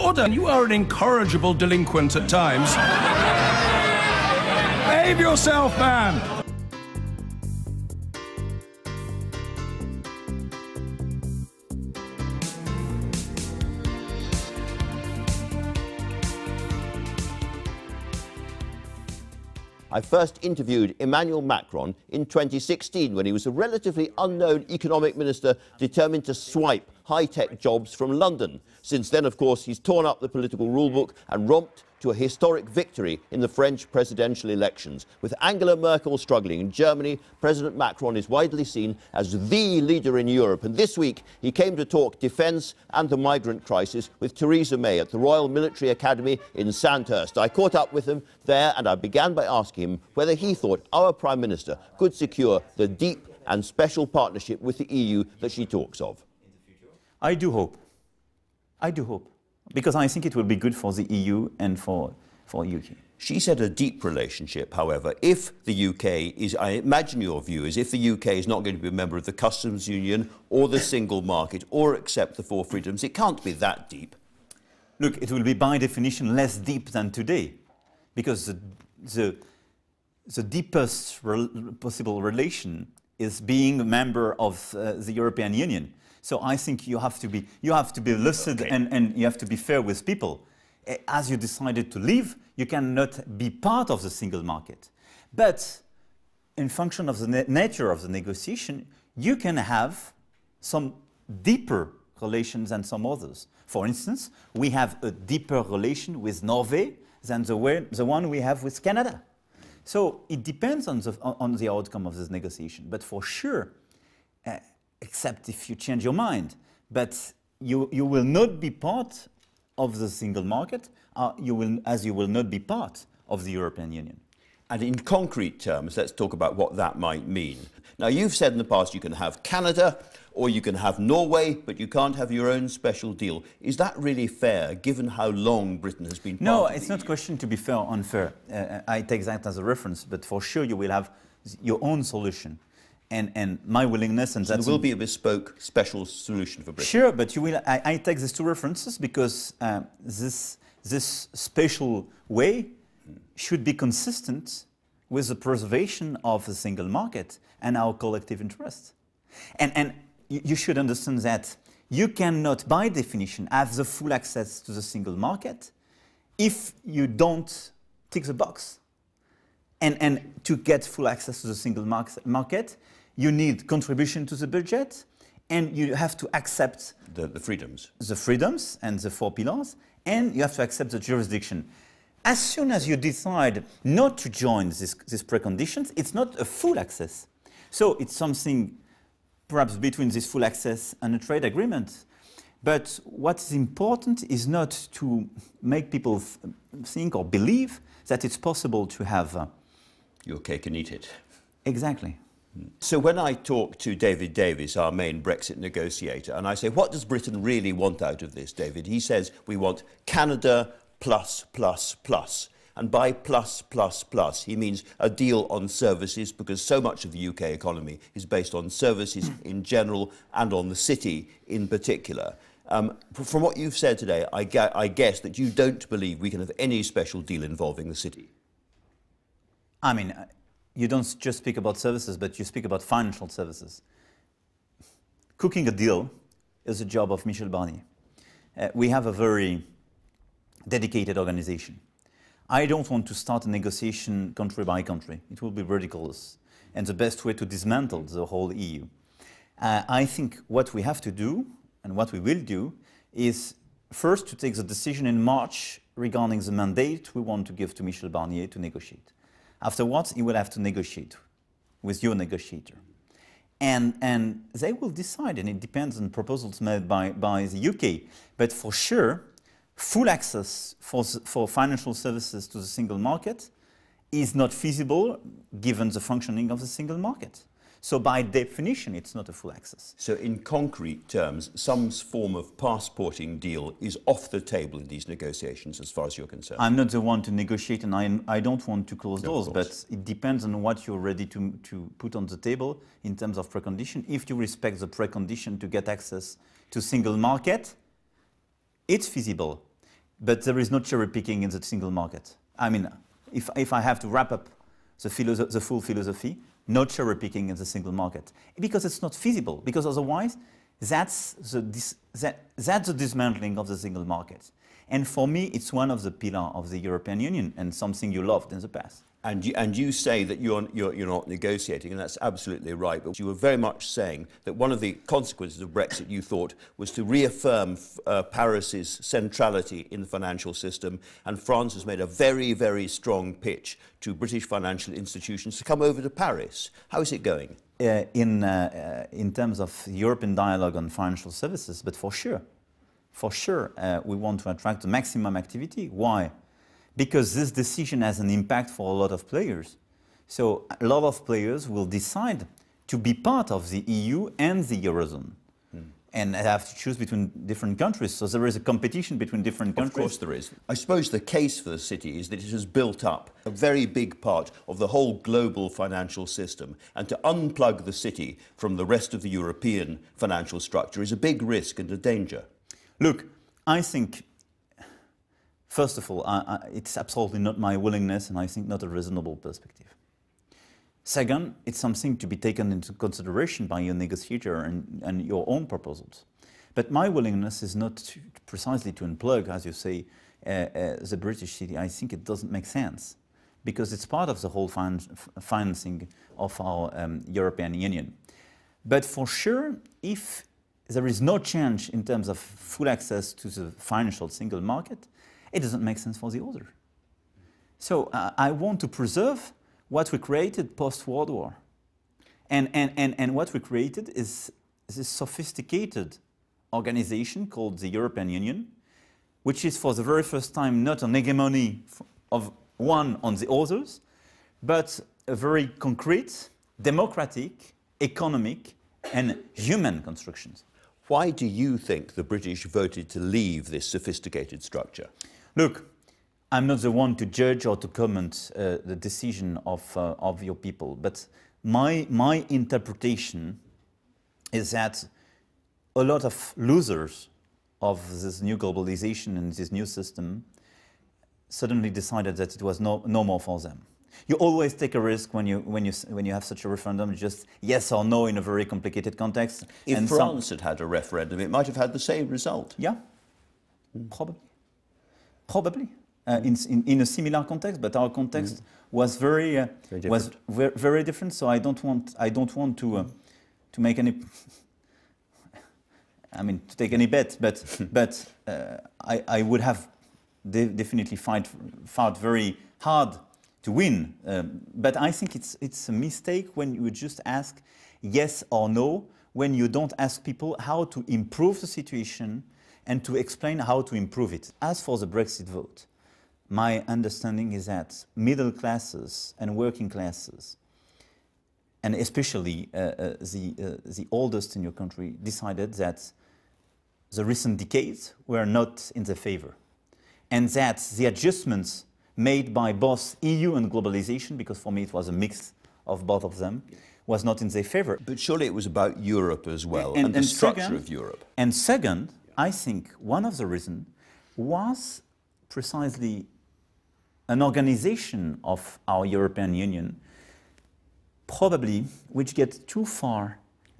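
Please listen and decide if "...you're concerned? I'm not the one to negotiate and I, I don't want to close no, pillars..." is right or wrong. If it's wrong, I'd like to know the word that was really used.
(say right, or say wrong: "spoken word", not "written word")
wrong: "doors", not "pillars".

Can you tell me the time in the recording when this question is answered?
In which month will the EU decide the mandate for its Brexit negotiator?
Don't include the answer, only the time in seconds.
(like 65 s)
255 s.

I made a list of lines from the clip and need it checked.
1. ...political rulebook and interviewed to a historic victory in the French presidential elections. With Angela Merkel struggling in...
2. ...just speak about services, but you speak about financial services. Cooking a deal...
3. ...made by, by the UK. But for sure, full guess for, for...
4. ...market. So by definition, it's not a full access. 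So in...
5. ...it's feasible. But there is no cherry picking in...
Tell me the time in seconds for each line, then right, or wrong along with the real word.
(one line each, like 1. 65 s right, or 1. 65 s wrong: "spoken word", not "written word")
1. 30 s wrong: "romped", not "interviewed"
2. 231 s right
3. 266 s wrong: "access", not "guess"
4. 276 s right
5. 298 s right.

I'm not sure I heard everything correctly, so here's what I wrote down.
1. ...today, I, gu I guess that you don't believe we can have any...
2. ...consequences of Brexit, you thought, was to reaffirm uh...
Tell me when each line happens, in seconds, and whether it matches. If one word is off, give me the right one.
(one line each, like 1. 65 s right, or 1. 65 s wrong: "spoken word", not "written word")
1. 223 s right
2. 325 s right.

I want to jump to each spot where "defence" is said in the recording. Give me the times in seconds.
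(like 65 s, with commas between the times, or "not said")
42 s.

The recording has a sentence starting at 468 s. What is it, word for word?
was very, uh, very was very different.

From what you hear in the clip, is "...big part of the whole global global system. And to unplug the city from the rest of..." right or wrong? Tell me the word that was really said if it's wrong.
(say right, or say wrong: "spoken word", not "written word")
wrong: "financial", not "global".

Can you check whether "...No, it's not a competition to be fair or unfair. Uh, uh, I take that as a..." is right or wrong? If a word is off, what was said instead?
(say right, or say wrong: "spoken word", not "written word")
wrong: "question", not "competition".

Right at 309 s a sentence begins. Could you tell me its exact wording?
Because otherwise, that's the, that, that's the dismantling of the single market.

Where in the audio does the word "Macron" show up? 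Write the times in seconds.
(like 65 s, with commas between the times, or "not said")
21 s, 37 s.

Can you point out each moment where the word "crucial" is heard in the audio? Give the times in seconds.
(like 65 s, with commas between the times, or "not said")
not said.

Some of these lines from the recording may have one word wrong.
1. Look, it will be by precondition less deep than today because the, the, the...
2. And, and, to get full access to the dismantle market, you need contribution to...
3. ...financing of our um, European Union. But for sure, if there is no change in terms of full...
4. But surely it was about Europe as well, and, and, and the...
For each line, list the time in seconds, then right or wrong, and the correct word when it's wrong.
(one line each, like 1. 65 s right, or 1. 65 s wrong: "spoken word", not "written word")
1. 74 s wrong: "definition", not "precondition"
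2. 169 s wrong: "single", not "dismantle"
3. 395 s right
4. 518 s right.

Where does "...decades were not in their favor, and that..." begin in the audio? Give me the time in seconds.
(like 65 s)
507 s.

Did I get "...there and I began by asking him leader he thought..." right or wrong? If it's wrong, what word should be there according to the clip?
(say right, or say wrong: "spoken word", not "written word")
wrong: "whether", not "leader".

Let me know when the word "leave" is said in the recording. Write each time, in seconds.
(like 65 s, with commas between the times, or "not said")
91 s, 433 s.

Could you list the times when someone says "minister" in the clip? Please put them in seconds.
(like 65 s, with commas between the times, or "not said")
25 s, 51 s.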